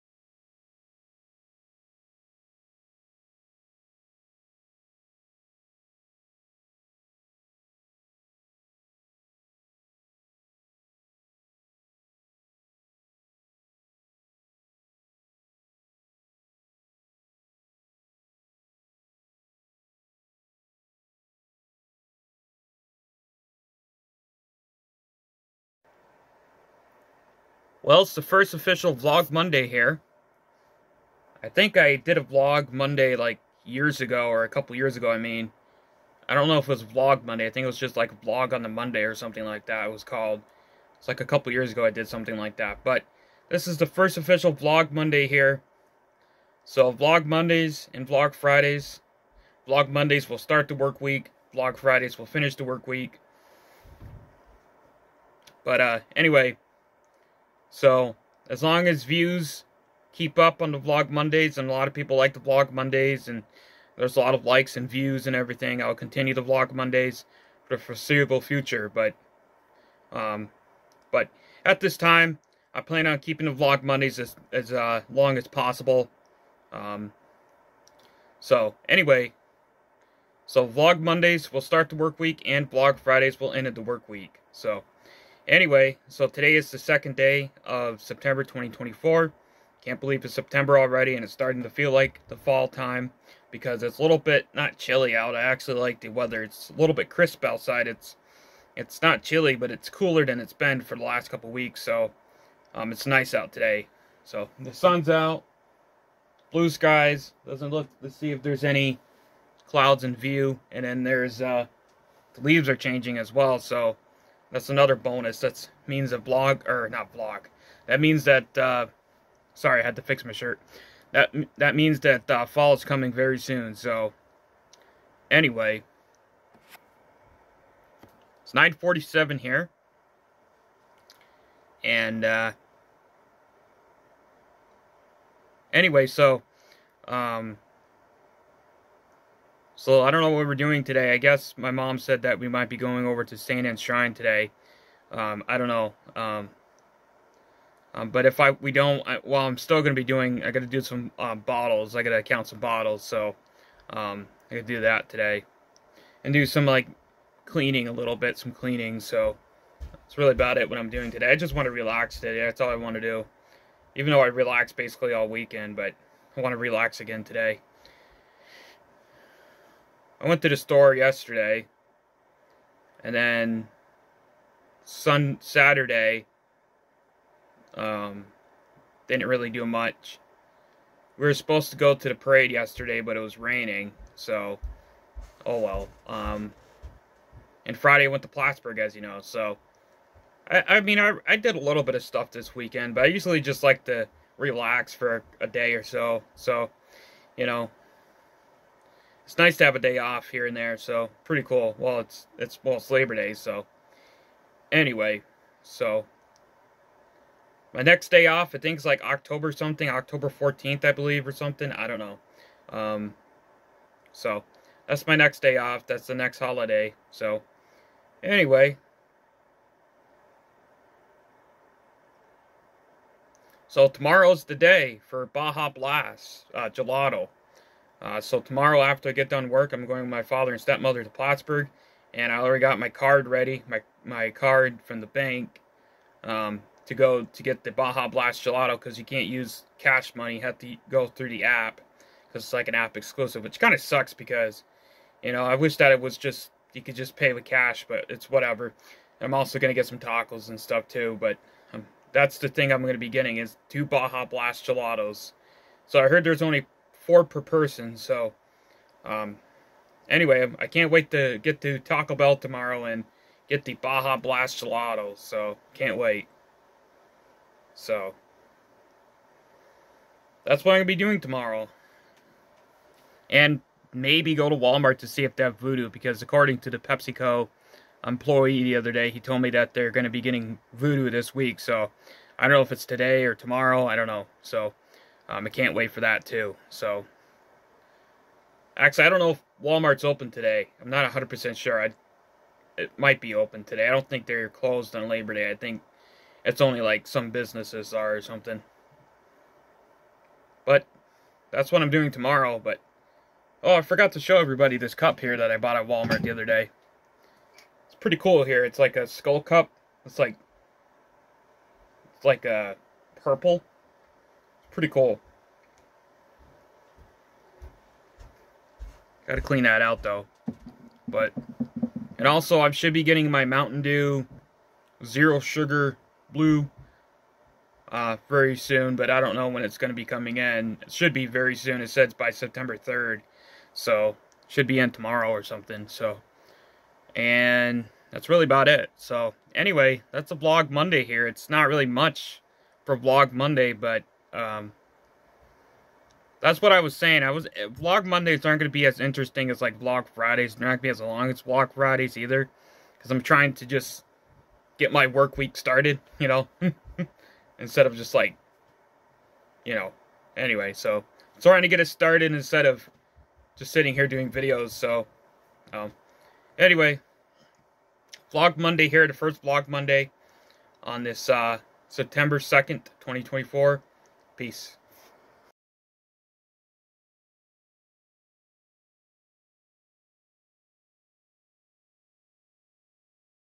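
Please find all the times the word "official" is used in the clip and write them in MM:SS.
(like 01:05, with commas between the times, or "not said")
00:28, 00:44.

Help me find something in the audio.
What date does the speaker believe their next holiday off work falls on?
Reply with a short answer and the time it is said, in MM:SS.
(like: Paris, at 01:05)
October 14th, at 03:29.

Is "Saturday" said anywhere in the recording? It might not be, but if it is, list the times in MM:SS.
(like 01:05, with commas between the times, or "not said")
02:55.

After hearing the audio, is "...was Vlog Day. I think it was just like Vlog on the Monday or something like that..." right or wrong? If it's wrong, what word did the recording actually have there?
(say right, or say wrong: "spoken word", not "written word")
wrong: "Monday", not "Day".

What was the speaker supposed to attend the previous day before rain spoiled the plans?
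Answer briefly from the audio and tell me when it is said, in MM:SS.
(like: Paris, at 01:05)
parade, at 03:02.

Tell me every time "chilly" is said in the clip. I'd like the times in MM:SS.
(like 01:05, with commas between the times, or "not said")
01:34, 01:39.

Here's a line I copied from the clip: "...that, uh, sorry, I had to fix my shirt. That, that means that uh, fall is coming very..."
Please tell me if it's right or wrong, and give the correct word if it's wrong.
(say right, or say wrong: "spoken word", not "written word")
right.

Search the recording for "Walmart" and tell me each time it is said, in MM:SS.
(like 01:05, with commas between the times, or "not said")
04:34, 04:49, 05:05.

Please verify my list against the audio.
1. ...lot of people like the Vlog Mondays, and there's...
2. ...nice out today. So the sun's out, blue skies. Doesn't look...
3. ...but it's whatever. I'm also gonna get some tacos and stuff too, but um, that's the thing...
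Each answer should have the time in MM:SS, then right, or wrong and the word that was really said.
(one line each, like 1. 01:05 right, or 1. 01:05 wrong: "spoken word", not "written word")
1. 01:01 right
2. 01:43 right
3. 04:07 right.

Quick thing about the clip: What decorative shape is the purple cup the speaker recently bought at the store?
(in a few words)
skull.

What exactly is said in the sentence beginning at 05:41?
It's not really much for Vlog Monday, but um, that's what I was saying.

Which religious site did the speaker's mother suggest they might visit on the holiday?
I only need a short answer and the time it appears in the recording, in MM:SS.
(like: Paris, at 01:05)
St. Anne's Shrine, at 02:23.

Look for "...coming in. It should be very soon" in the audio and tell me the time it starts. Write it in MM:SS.
05:30.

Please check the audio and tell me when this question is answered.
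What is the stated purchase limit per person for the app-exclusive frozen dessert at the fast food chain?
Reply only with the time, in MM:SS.
04:17.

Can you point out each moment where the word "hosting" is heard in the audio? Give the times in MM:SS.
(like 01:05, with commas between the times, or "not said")
not said.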